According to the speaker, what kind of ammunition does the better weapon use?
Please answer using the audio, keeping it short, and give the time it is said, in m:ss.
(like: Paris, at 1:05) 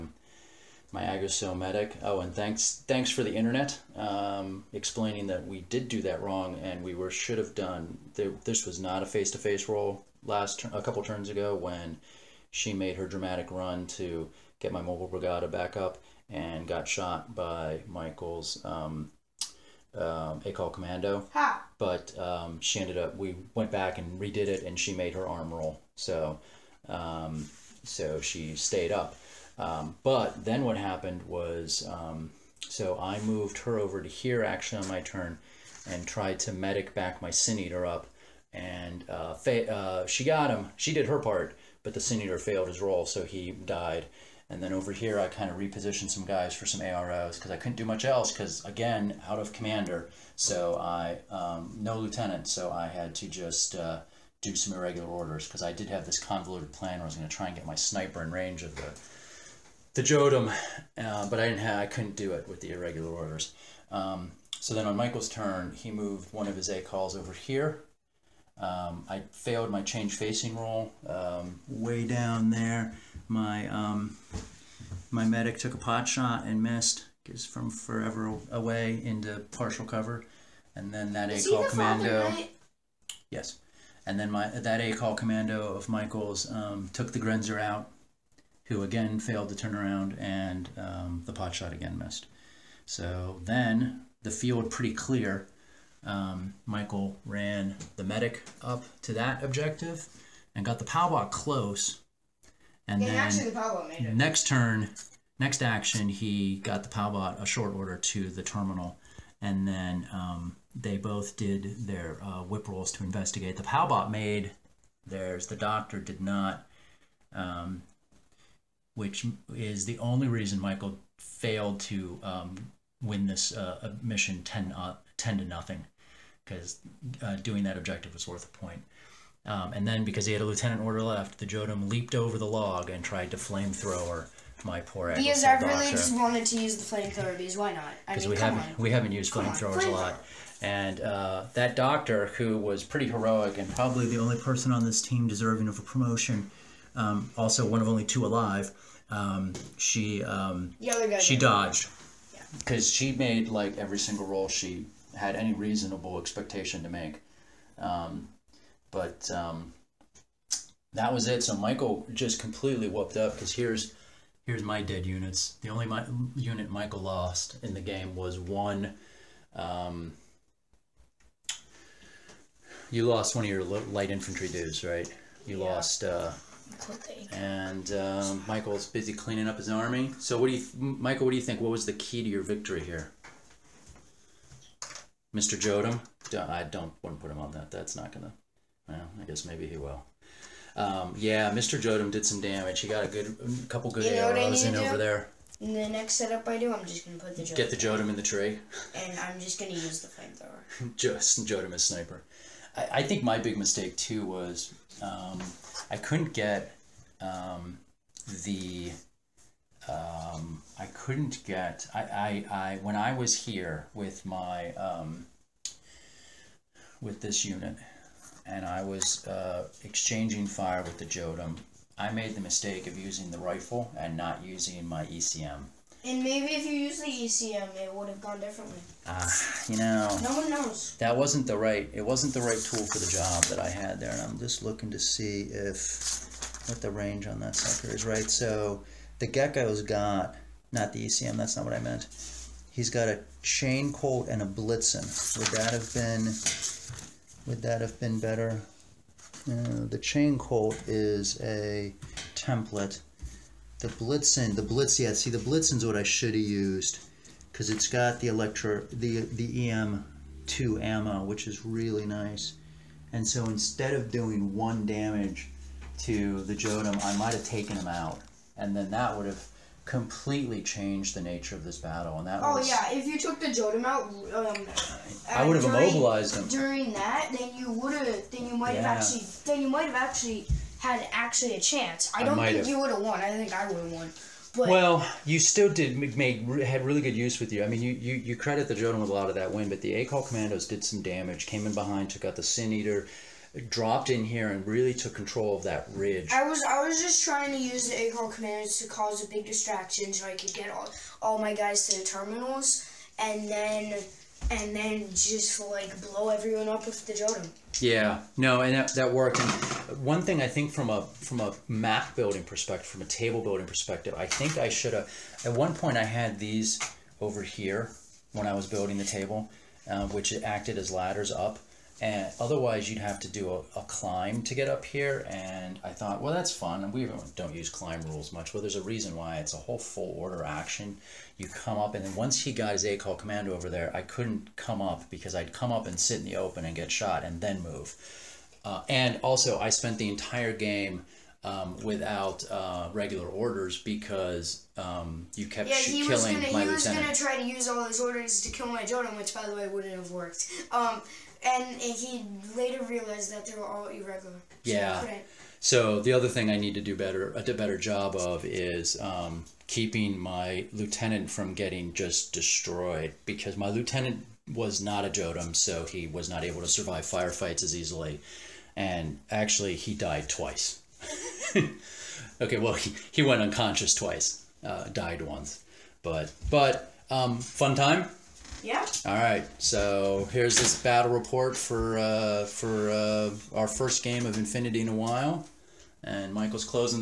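EM2, at 4:19.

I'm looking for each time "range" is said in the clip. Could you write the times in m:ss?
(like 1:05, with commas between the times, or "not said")
0:58, 3:56.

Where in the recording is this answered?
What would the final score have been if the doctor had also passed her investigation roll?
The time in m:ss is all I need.
2:05.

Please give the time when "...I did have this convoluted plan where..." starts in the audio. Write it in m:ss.
0:55.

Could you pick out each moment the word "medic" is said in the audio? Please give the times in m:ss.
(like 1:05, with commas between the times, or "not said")
0:01, 0:36, 1:15, 1:38.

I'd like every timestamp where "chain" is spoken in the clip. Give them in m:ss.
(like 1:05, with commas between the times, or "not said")
4:03, 4:10.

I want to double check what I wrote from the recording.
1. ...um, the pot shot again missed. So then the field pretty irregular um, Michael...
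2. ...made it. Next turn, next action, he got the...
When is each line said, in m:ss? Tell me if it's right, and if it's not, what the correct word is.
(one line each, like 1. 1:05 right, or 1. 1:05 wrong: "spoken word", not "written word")
1. 1:30 wrong: "clear", not "irregular"
2. 1:43 right.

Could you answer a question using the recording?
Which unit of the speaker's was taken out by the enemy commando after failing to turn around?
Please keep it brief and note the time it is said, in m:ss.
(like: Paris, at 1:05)
Grenzer, at 1:27.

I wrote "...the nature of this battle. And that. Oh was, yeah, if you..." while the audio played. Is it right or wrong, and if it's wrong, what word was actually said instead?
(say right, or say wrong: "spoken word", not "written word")
right.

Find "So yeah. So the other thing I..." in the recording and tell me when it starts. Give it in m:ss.
5:54.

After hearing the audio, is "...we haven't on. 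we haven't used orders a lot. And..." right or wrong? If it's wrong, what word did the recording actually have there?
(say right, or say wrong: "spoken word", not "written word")
wrong: "flamethrowers", not "orders".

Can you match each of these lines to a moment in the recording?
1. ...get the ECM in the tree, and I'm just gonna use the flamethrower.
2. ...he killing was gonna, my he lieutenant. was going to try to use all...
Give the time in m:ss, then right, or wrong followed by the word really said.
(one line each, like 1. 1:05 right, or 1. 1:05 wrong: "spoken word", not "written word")
1. 3:17 wrong: "Jotum", not "ECM"
2. 5:45 right.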